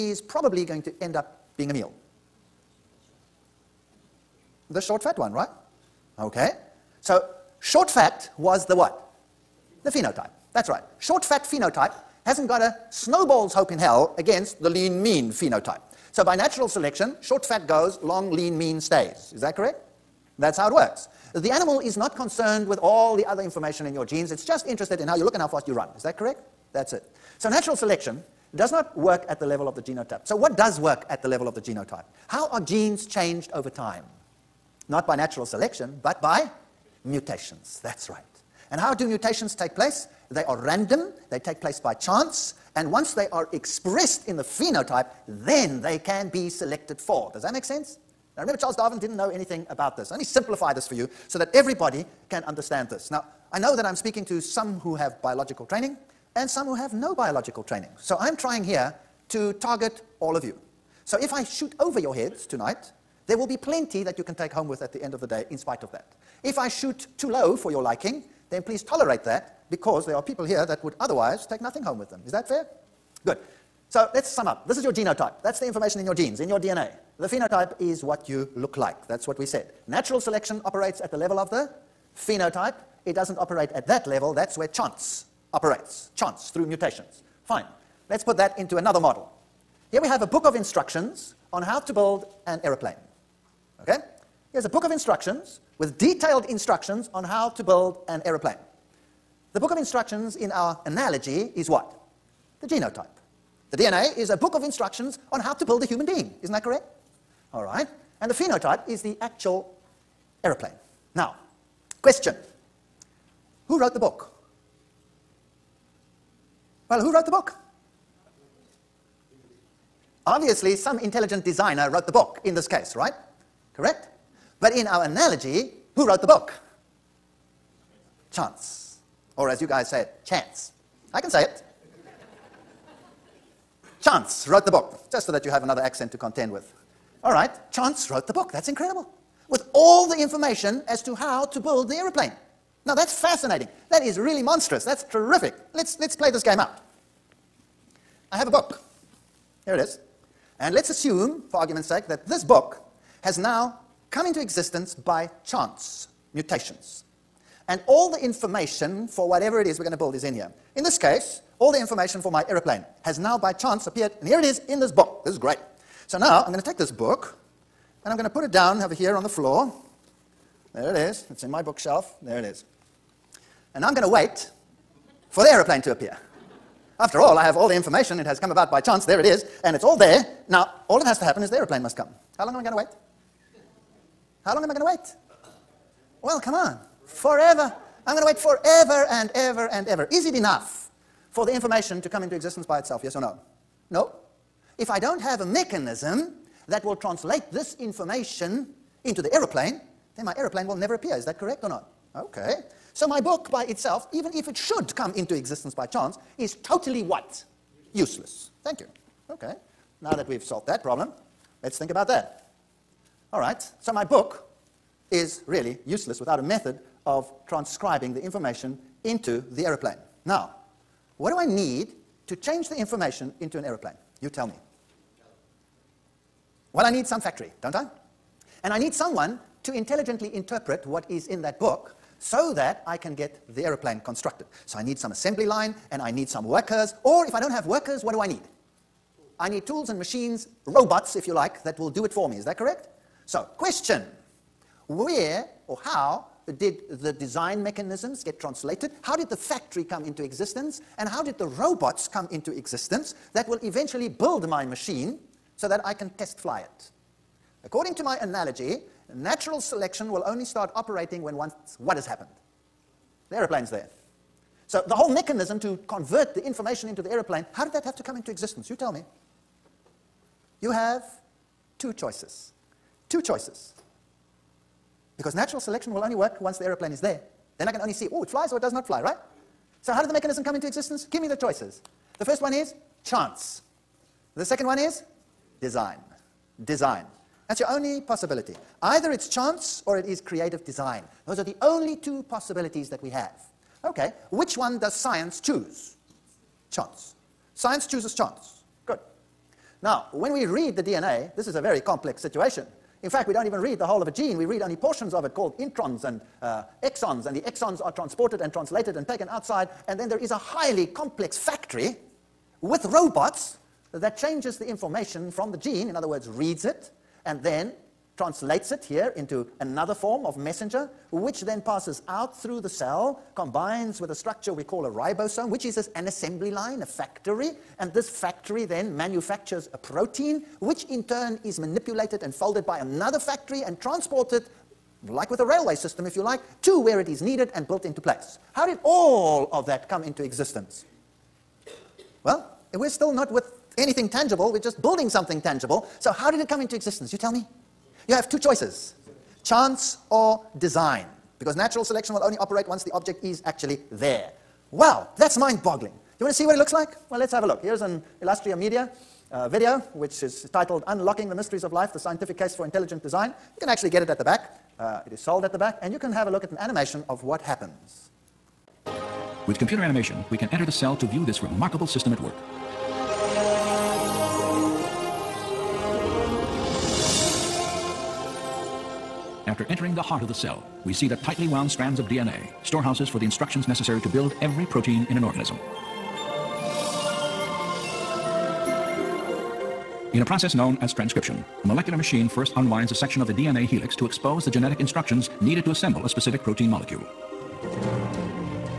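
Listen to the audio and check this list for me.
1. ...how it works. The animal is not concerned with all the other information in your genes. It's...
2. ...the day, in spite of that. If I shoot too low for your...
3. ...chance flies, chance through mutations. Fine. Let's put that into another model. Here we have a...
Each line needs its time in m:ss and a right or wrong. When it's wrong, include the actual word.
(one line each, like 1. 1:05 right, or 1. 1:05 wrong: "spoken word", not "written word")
1. 0:20 right
2. 1:05 right
3. 1:24 wrong: "operates", not "flies".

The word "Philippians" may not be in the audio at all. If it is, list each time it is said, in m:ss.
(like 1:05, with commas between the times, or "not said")
not said.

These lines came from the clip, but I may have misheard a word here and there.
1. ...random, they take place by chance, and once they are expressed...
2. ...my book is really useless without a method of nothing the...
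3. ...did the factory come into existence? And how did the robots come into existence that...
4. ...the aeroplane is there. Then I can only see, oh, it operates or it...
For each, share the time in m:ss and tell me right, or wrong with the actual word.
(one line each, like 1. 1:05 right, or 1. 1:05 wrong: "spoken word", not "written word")
1. 0:40 right
2. 3:33 wrong: "transcribing", not "nothing"
3. 4:09 right
4. 4:36 wrong: "flies", not "operates".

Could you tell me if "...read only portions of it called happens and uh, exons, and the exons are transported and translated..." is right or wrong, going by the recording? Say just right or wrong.
wrong.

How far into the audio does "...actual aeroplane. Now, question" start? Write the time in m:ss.
1:49.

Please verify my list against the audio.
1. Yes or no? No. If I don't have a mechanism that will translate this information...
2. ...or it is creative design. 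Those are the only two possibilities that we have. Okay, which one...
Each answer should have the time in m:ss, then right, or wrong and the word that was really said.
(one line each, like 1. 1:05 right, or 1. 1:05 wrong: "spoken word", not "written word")
1. 3:13 right
2. 4:49 right.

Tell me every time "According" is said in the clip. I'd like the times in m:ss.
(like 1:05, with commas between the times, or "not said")
4:17.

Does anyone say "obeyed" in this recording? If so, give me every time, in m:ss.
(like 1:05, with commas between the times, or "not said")
not said.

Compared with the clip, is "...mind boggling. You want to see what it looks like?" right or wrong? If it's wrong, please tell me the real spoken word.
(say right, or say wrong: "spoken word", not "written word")
right.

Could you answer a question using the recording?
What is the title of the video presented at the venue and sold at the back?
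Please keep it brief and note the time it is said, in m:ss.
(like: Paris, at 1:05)
Unlocking the Mysteries of Life, at 6:00.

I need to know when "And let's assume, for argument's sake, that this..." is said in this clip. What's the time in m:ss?
2:30.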